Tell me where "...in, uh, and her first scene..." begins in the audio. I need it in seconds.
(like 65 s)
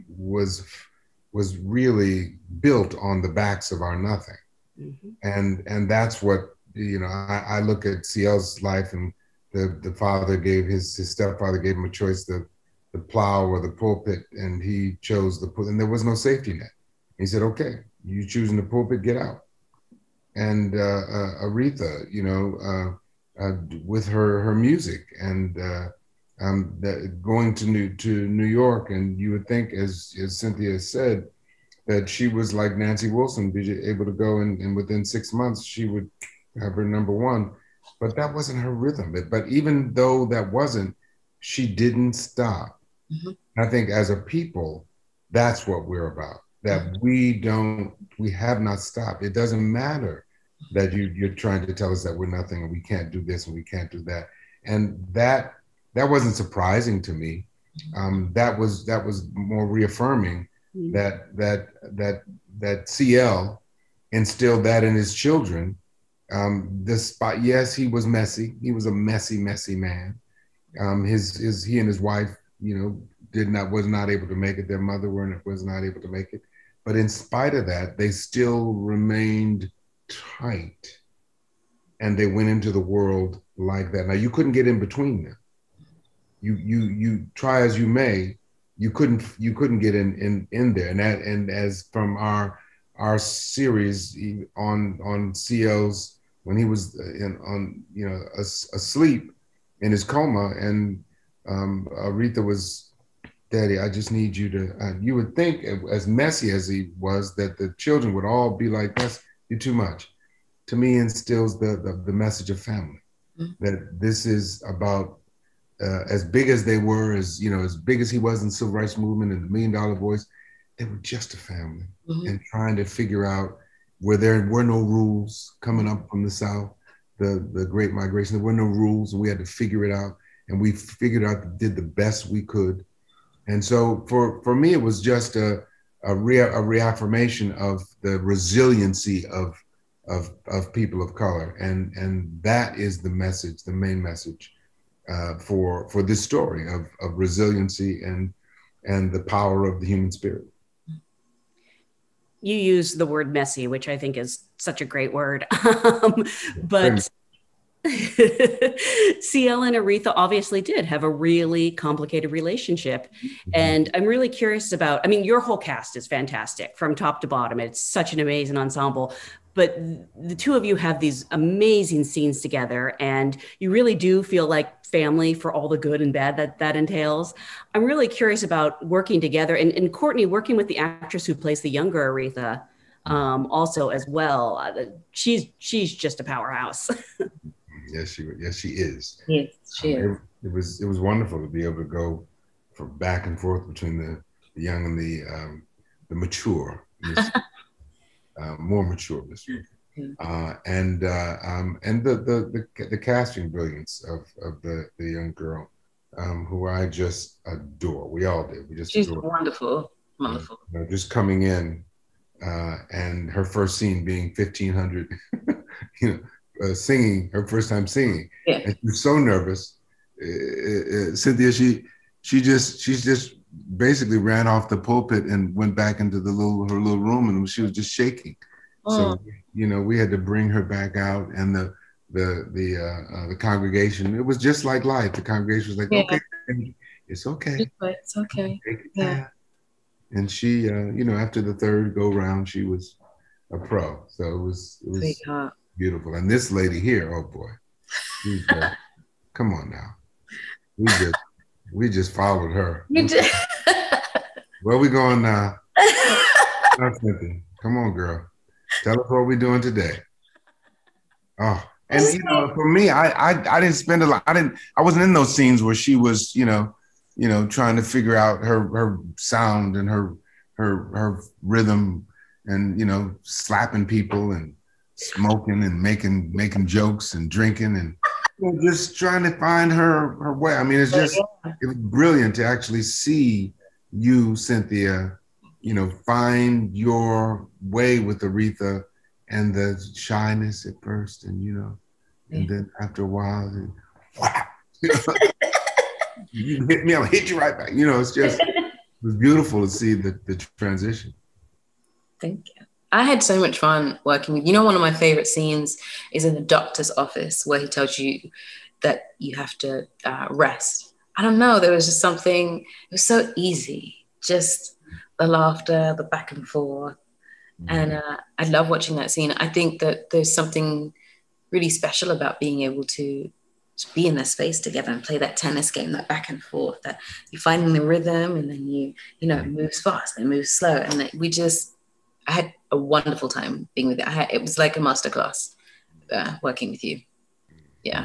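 211 s.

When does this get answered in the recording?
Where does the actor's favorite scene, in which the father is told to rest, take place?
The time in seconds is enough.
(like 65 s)
306 s.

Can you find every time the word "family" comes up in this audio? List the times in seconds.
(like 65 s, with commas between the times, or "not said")
112 s, 121 s, 174 s.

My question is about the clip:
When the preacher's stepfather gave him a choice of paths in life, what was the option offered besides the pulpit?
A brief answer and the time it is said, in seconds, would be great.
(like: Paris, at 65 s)
The plow, at 12 s.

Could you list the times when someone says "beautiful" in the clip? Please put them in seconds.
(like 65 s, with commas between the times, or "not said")
245 s, 299 s.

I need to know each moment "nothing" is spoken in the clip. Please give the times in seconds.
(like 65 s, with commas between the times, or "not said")
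3 s, 52 s.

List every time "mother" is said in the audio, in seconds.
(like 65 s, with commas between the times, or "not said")
74 s.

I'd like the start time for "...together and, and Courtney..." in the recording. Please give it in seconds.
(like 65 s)
179 s.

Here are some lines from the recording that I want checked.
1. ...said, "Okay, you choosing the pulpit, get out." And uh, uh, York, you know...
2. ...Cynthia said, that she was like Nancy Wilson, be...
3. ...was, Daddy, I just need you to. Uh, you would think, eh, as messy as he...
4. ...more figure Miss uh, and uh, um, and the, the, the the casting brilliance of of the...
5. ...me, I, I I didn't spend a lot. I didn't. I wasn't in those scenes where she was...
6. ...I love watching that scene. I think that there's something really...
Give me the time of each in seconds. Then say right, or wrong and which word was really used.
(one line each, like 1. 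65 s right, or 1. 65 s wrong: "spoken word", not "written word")
1. 17 s wrong: "Aretha", not "York"
2. 30 s right
3. 102 s right
4. 198 s wrong: "mature", not "figure"
5. 262 s right
6. 318 s right.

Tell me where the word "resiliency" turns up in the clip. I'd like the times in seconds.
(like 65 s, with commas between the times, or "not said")
138 s, 147 s.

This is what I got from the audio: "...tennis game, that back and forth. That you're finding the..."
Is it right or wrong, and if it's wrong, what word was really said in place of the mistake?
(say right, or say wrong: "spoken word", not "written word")
right.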